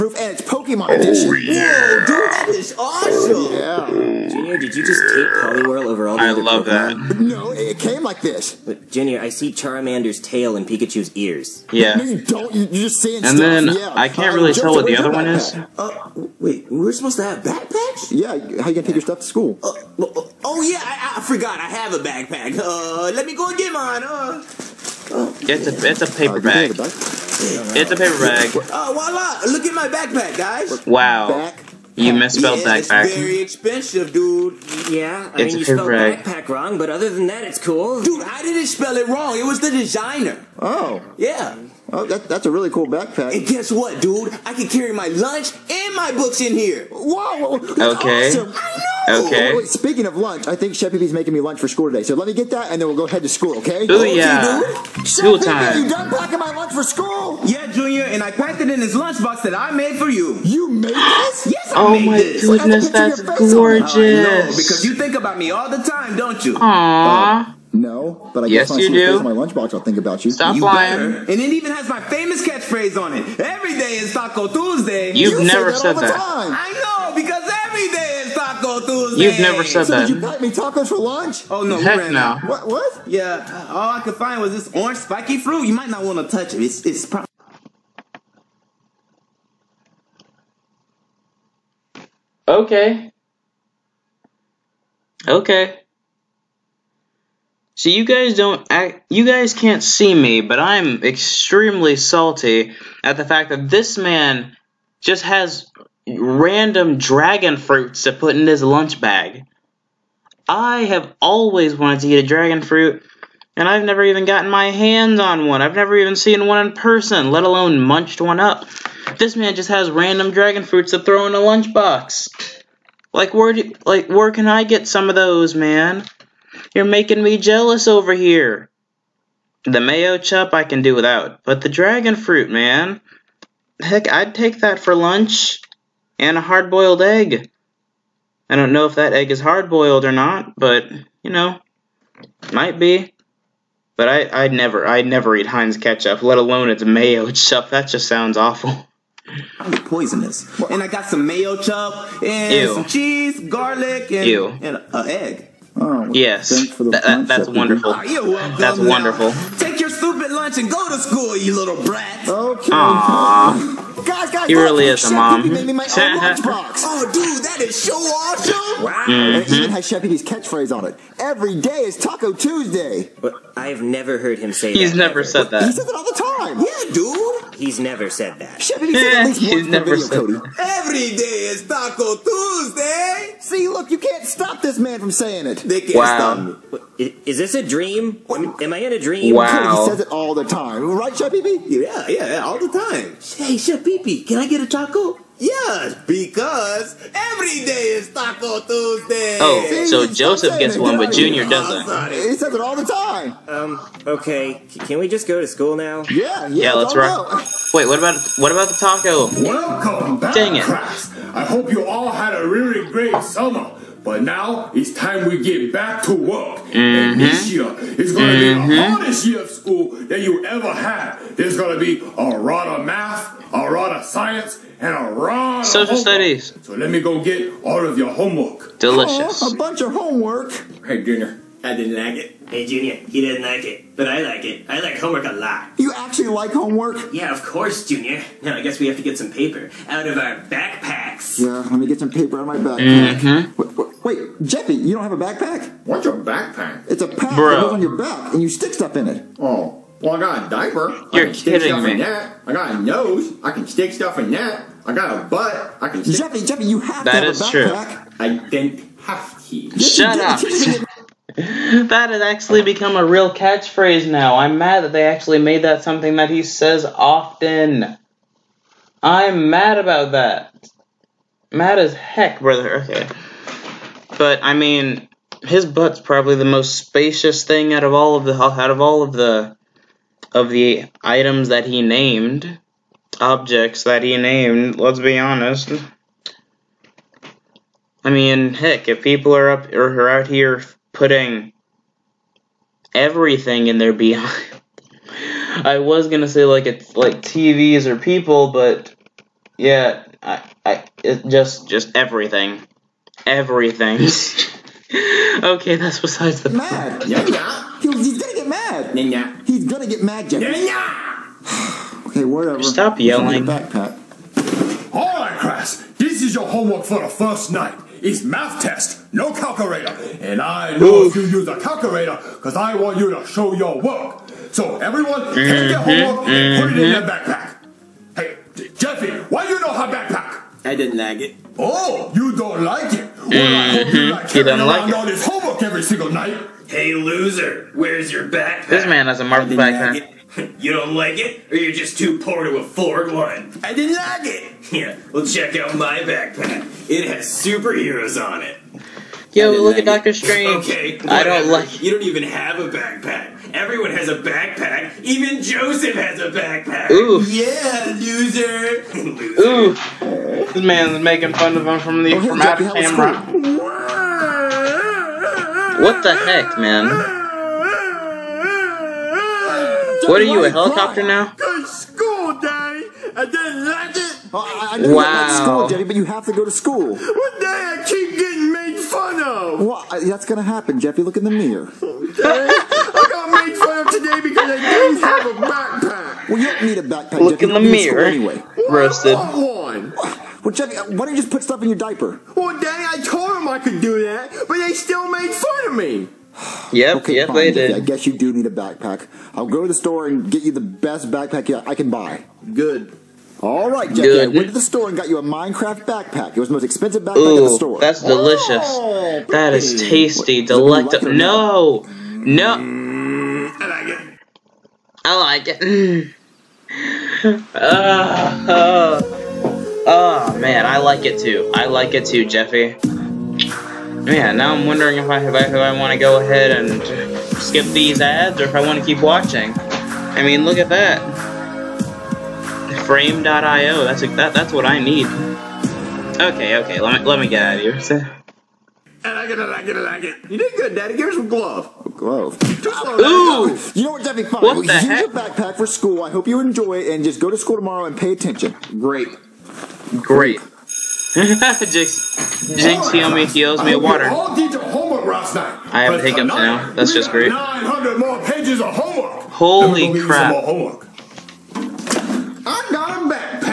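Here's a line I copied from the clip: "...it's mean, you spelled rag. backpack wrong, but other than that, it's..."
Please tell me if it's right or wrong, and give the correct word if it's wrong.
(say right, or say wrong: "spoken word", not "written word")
right.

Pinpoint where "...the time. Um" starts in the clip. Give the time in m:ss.
3:22.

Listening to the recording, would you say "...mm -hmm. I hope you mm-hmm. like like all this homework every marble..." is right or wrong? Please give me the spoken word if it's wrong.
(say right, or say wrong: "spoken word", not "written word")
wrong: "single", not "marble".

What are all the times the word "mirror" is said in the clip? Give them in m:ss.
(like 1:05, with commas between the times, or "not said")
6:21, 6:27.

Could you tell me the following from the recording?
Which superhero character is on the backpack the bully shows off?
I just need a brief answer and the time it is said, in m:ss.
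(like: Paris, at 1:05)
Doctor Strange, at 5:49.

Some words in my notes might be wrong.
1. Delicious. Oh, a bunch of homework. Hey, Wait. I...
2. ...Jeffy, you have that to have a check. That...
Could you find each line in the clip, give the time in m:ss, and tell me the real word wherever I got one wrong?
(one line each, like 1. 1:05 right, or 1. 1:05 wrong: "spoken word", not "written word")
1. 3:48 wrong: "Junior", not "Wait"
2. 4:16 wrong: "backpack", not "check".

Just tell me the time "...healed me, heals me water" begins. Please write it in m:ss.
7:32.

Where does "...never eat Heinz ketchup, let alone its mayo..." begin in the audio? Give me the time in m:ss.
2:25.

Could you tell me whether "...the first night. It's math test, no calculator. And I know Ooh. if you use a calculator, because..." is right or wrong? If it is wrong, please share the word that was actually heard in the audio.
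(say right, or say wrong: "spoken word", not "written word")
right.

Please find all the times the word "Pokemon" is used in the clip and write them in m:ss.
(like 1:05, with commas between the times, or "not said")
0:00, 0:06.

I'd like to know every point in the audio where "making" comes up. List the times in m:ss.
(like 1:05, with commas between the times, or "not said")
0:51, 2:06, 6:01.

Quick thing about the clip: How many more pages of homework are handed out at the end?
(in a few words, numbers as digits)
900.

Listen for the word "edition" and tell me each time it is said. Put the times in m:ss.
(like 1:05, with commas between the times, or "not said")
0:00.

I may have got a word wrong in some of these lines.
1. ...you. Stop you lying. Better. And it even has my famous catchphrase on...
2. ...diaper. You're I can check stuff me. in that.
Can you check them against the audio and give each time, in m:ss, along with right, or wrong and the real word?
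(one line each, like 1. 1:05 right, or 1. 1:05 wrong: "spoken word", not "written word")
1. 1:10 right
2. 4:10 wrong: "stick", not "check".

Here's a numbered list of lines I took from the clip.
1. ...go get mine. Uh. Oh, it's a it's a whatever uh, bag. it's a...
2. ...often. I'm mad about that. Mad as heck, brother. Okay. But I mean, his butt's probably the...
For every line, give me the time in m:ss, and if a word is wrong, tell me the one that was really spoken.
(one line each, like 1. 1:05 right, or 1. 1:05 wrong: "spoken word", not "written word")
1. 0:23 wrong: "paper", not "whatever"
2. 4:26 right.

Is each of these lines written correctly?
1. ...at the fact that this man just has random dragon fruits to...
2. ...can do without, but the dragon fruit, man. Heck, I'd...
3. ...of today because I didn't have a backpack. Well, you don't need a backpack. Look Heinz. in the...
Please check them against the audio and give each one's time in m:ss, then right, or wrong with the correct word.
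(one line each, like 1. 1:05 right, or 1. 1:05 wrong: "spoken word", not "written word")
1. 1:43 right
2. 2:10 right
3. 6:23 wrong: "Jeffy", not "Heinz".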